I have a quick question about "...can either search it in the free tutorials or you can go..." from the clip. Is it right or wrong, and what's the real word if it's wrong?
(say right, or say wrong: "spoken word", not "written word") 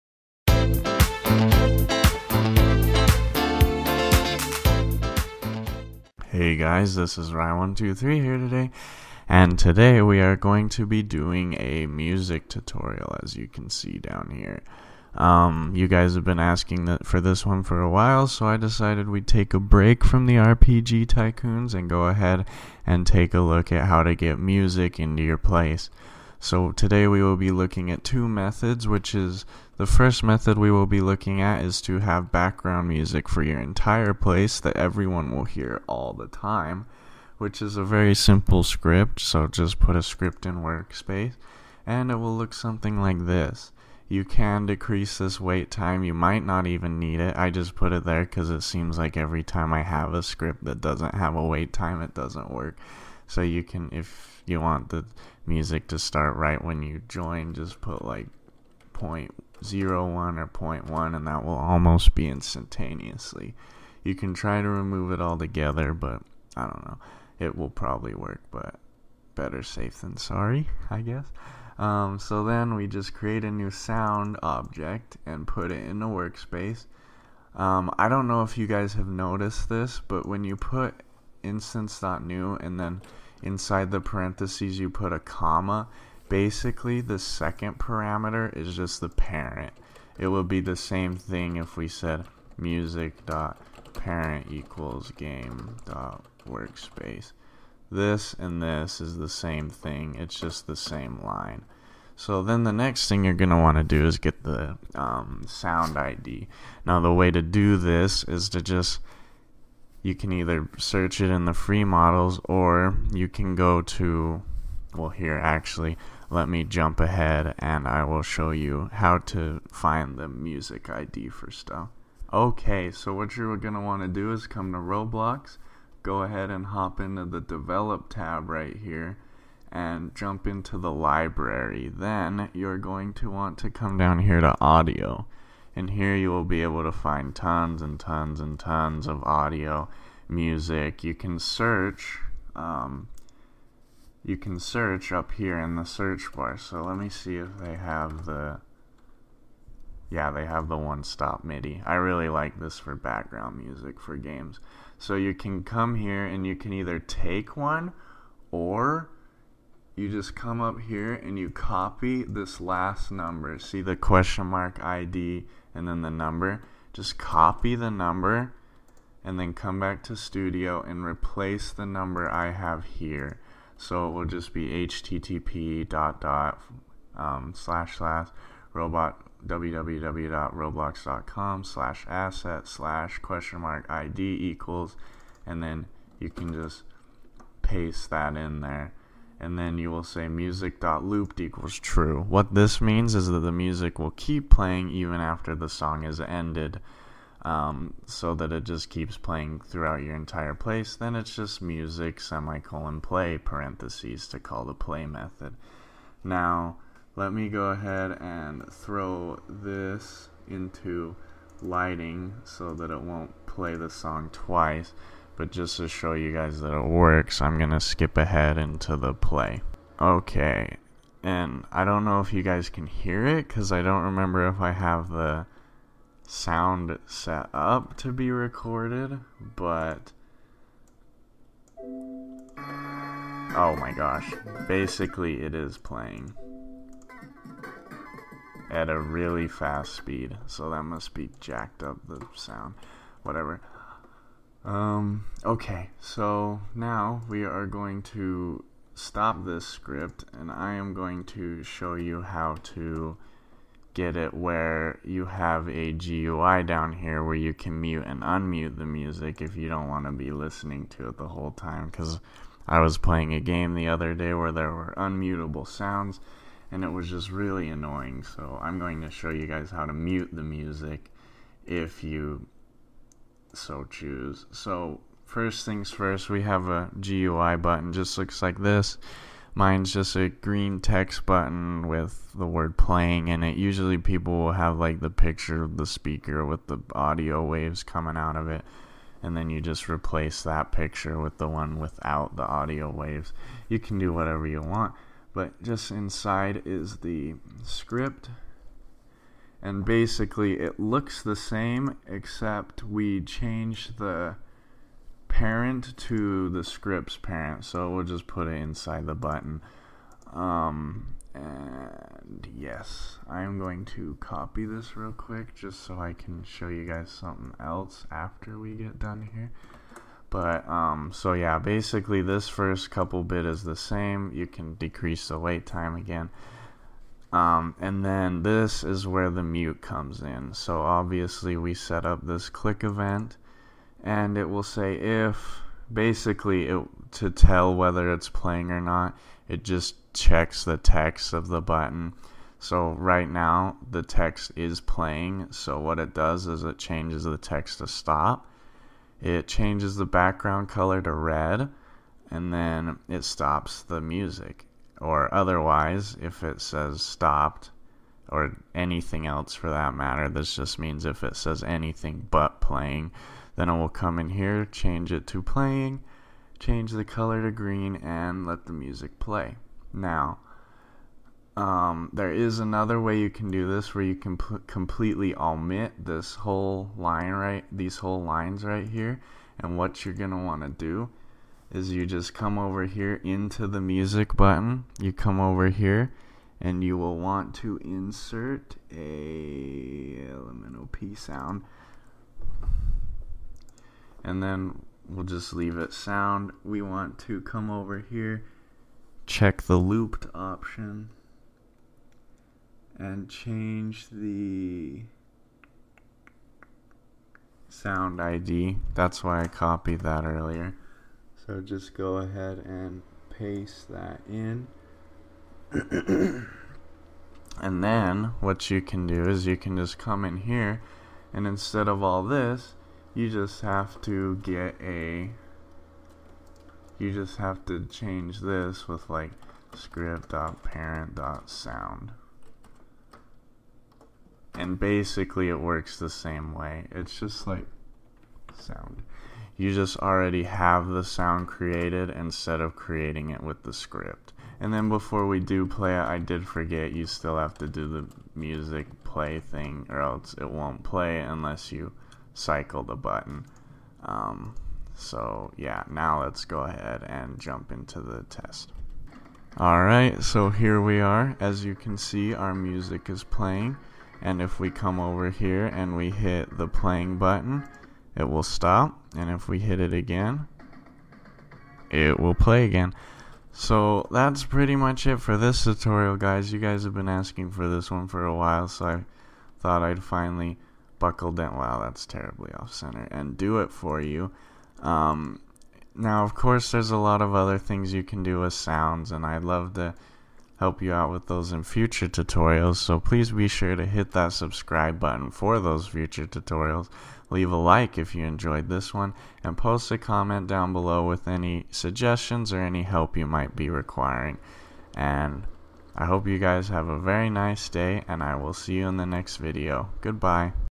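wrong: "models", not "tutorials".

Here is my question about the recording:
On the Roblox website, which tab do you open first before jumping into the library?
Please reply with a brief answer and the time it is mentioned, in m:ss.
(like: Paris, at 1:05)
Develop, at 2:07.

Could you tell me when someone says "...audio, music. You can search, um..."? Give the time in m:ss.
2:19.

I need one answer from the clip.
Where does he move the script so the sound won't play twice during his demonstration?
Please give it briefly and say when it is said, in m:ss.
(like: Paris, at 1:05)
Lighting, at 3:31.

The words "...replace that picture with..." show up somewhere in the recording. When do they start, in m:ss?
4:49.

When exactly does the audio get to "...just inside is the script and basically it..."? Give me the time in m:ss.
4:55.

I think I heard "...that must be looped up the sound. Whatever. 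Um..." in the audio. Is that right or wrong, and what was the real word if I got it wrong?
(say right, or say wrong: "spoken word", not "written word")
wrong: "jacked", not "looped".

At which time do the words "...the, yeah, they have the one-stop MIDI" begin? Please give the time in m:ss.
2:28.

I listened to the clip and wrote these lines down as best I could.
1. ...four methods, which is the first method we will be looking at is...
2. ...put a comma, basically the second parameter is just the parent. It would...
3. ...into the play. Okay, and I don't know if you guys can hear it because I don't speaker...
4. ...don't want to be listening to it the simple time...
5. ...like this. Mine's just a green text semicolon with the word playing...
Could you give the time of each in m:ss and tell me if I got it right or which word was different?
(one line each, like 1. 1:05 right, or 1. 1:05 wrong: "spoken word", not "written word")
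1. 0:28 wrong: "two", not "four"
2. 1:24 right
3. 3:38 wrong: "remember", not "speaker"
4. 4:19 wrong: "whole", not "simple"
5. 4:38 wrong: "button", not "semicolon".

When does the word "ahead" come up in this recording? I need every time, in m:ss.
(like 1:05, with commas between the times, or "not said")
0:22, 1:56, 2:06, 3:27, 3:38, 6:52, 7:36.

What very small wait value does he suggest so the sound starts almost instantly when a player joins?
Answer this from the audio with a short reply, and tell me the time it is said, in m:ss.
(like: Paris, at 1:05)
0.01, at 0:58.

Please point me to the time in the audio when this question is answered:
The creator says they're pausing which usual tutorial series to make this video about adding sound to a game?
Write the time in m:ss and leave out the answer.
0:20.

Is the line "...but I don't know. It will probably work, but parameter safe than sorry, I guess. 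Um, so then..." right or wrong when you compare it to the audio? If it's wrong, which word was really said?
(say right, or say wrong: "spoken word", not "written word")
wrong: "better", not "parameter".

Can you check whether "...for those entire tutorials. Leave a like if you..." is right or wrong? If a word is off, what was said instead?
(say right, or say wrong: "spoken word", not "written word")
wrong: "future", not "entire".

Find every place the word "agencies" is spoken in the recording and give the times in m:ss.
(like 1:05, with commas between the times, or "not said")
not said.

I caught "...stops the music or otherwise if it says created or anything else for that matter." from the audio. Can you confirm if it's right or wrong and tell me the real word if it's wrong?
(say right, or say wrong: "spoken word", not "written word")
wrong: "stopped", not "created".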